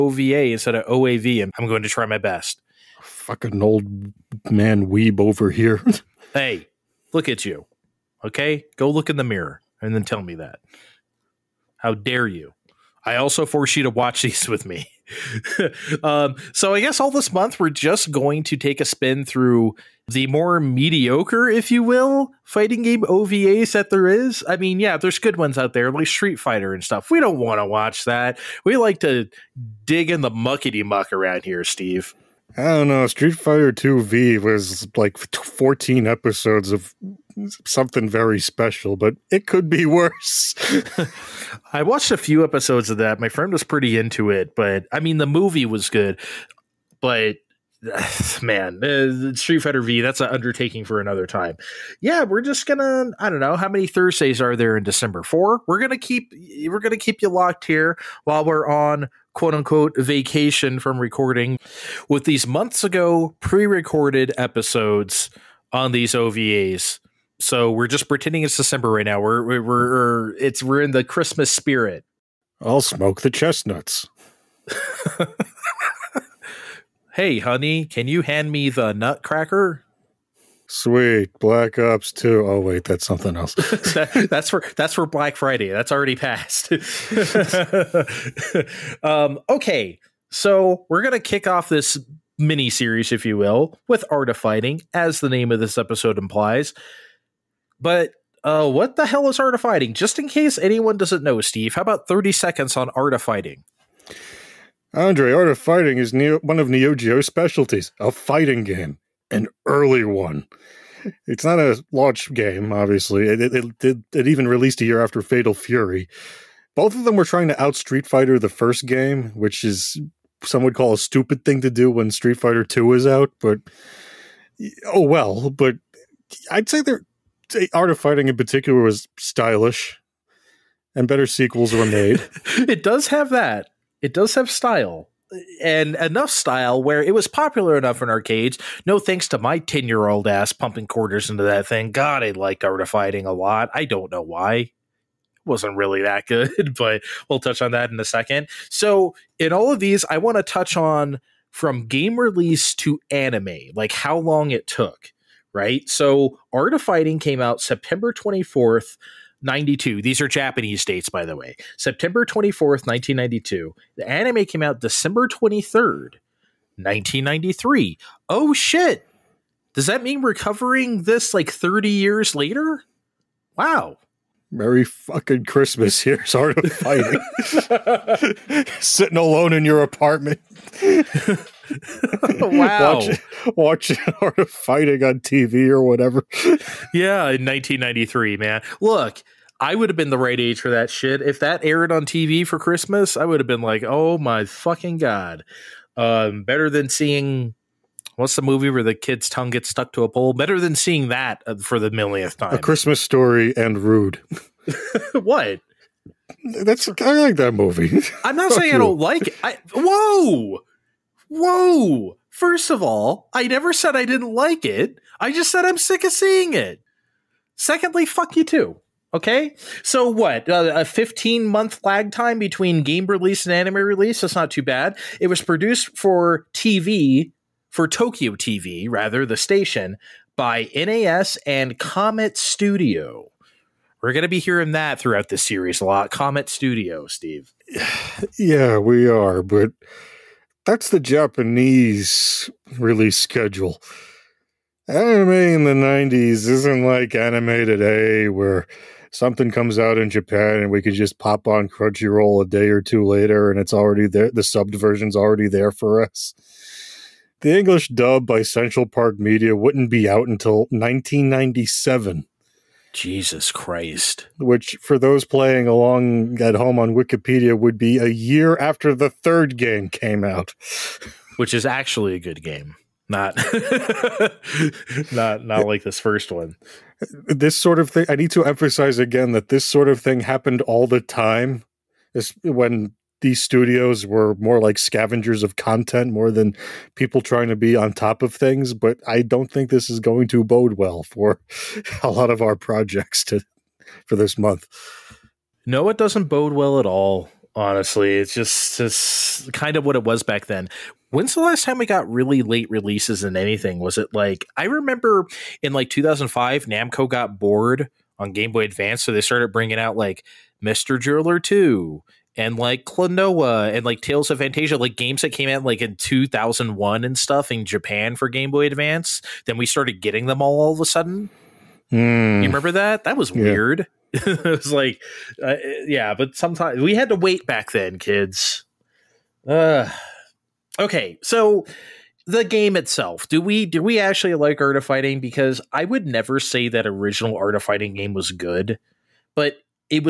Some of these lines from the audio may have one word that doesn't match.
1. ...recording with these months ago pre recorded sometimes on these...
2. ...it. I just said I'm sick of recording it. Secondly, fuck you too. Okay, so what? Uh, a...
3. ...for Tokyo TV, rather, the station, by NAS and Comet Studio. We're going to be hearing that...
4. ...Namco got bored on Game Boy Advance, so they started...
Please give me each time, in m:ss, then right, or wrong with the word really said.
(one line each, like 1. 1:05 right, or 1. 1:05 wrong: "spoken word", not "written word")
1. 1:00 wrong: "episodes", not "sometimes"
2. 3:34 wrong: "seeing", not "recording"
3. 3:47 right
4. 5:06 right.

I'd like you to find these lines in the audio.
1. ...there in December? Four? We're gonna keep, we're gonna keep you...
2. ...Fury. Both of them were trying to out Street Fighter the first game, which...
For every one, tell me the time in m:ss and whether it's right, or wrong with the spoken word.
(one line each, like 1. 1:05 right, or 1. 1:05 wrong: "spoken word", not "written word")
1. 0:54 right
2. 1:55 right.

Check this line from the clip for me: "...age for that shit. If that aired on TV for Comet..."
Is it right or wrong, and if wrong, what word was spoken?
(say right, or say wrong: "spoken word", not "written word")
wrong: "Christmas", not "Comet".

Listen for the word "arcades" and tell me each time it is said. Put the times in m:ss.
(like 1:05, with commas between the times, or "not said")
2:18.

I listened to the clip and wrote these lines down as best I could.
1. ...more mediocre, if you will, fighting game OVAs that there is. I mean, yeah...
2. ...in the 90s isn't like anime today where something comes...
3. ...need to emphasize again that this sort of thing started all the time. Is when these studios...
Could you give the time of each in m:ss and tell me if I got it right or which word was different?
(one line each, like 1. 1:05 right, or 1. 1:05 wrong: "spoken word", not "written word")
1. 0:20 right
2. 4:05 right
3. 4:38 wrong: "happened", not "started".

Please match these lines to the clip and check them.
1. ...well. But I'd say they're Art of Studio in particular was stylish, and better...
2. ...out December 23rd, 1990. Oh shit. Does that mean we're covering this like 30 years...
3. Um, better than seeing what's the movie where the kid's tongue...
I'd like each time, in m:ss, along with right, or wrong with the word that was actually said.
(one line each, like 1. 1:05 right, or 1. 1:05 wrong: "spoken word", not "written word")
1. 2:05 wrong: "Fighting", not "Studio"
2. 2:44 wrong: "1993", not "1990"
3. 3:15 right.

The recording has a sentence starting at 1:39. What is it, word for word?
Just in case anyone doesn't know, Steve, how about 30 seconds on art of fighting?